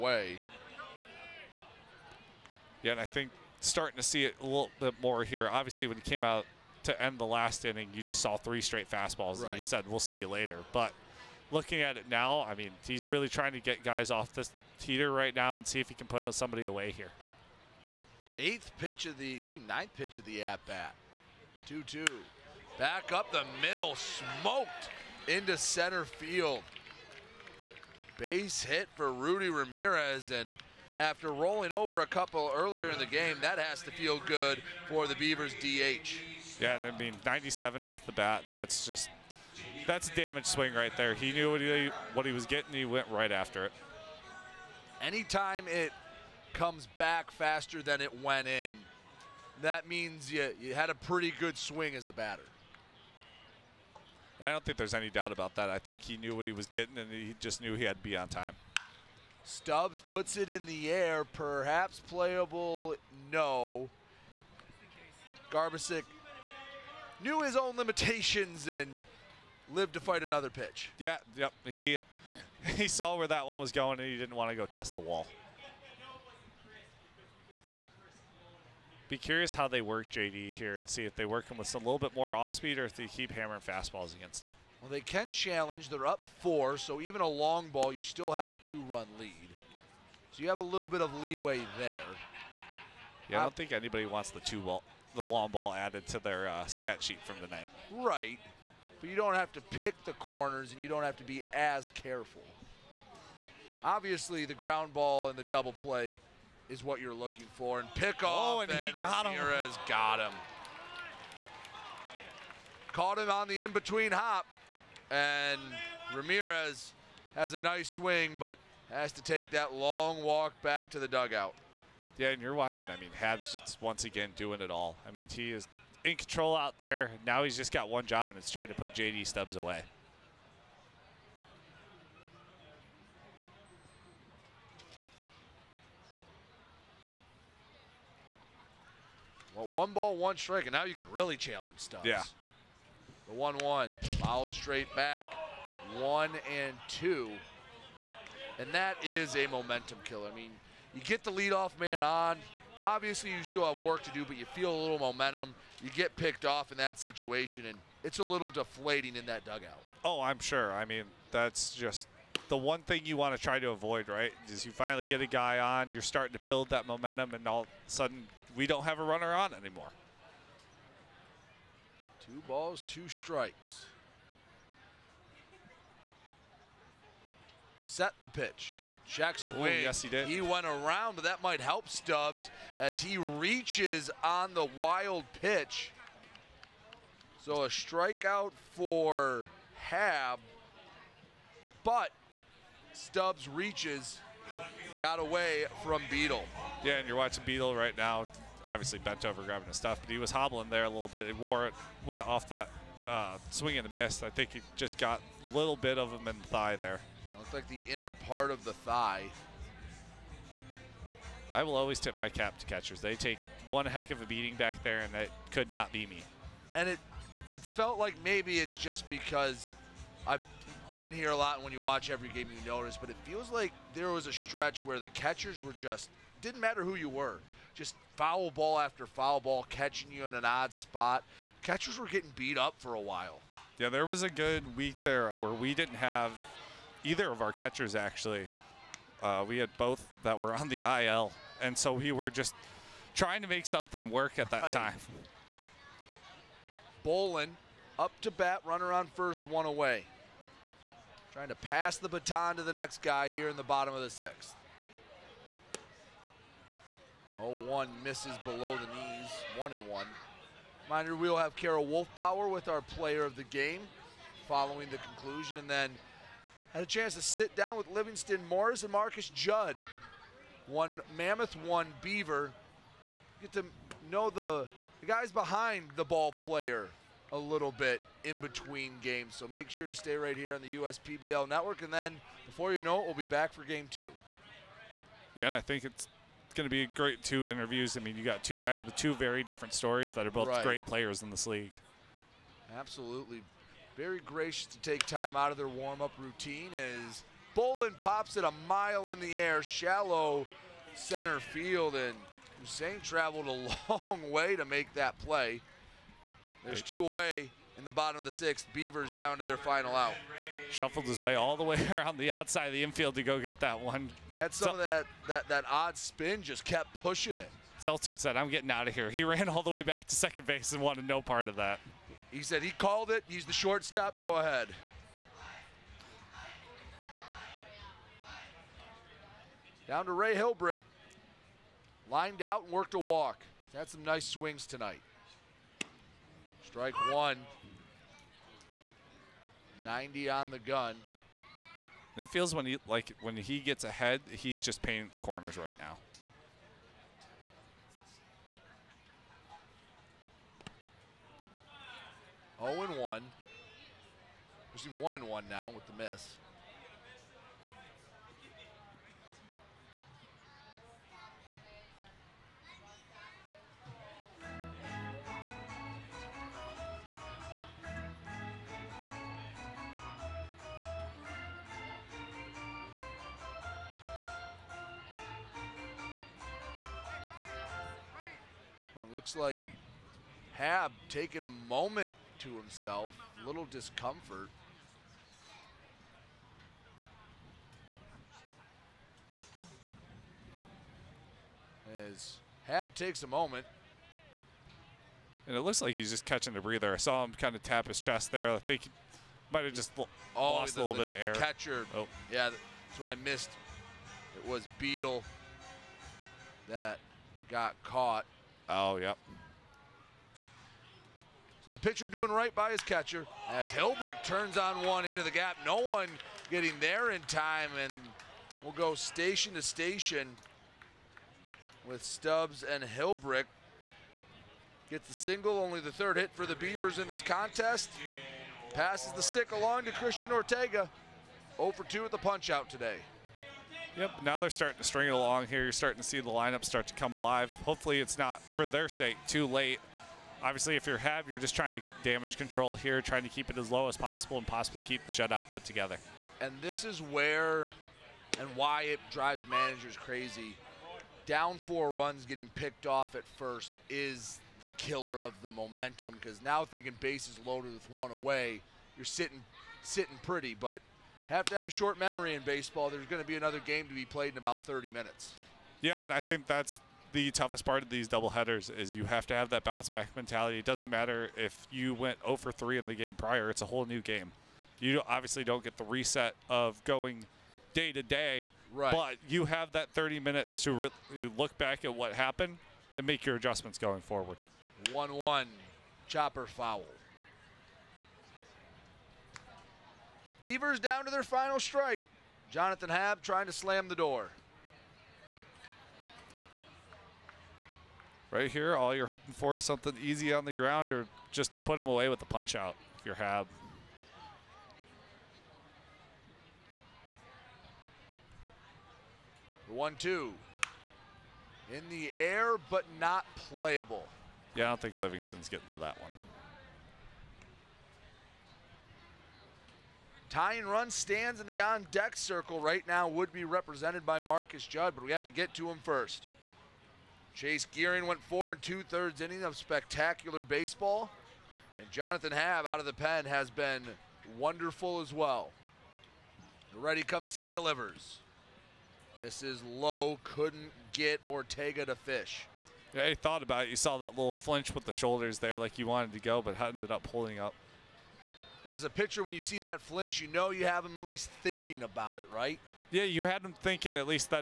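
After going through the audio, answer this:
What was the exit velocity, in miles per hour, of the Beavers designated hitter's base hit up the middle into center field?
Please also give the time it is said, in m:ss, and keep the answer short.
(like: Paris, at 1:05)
97, at 0:37.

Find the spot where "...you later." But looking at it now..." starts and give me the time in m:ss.
0:10.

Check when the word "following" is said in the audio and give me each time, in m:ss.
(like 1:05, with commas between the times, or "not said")
4:24.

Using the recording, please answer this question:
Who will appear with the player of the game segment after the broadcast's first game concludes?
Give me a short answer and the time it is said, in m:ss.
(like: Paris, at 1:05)
Carol Wolfbauer, at 4:21.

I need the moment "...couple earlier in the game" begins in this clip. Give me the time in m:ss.
0:32.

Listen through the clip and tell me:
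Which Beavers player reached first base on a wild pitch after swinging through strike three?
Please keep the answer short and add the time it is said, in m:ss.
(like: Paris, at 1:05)
JD Stubbs, at 3:12.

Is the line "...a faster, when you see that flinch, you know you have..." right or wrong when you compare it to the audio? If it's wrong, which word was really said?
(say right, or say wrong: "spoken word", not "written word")
wrong: "pitcher", not "faster".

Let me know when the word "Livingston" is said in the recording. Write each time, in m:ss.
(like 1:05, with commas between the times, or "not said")
4:27, 8:34.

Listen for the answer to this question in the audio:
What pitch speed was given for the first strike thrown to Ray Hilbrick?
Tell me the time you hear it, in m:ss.
5:39.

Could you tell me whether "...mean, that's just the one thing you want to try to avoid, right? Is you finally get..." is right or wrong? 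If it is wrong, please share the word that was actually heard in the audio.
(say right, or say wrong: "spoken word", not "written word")
right.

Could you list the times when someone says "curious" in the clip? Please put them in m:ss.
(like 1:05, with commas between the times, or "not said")
1:19.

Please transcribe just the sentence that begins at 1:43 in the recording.
Obviously, the ground ball and the double play is what you're looking for, and pick oh, off.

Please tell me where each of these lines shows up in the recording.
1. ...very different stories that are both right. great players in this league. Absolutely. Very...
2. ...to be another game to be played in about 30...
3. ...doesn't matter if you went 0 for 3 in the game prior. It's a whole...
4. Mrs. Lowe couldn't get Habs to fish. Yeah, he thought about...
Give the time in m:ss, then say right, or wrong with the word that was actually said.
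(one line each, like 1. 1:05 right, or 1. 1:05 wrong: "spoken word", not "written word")
1. 4:49 right
2. 7:43 right
3. 7:50 right
4. 8:59 wrong: "Ortega", not "Habs".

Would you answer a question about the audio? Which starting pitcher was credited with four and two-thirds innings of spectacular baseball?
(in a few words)
Chase Gearing.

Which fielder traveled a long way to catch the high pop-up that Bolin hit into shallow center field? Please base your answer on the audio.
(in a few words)
Hussein.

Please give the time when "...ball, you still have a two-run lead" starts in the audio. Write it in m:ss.
1:27.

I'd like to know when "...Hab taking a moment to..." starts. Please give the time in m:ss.
6:20.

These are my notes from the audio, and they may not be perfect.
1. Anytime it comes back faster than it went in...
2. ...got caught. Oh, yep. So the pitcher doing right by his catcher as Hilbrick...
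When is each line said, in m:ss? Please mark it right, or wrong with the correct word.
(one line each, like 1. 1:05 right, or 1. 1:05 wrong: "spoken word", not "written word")
1. 0:45 right
2. 6:47 right.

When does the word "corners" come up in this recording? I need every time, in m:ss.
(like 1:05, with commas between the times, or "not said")
1:40, 5:45.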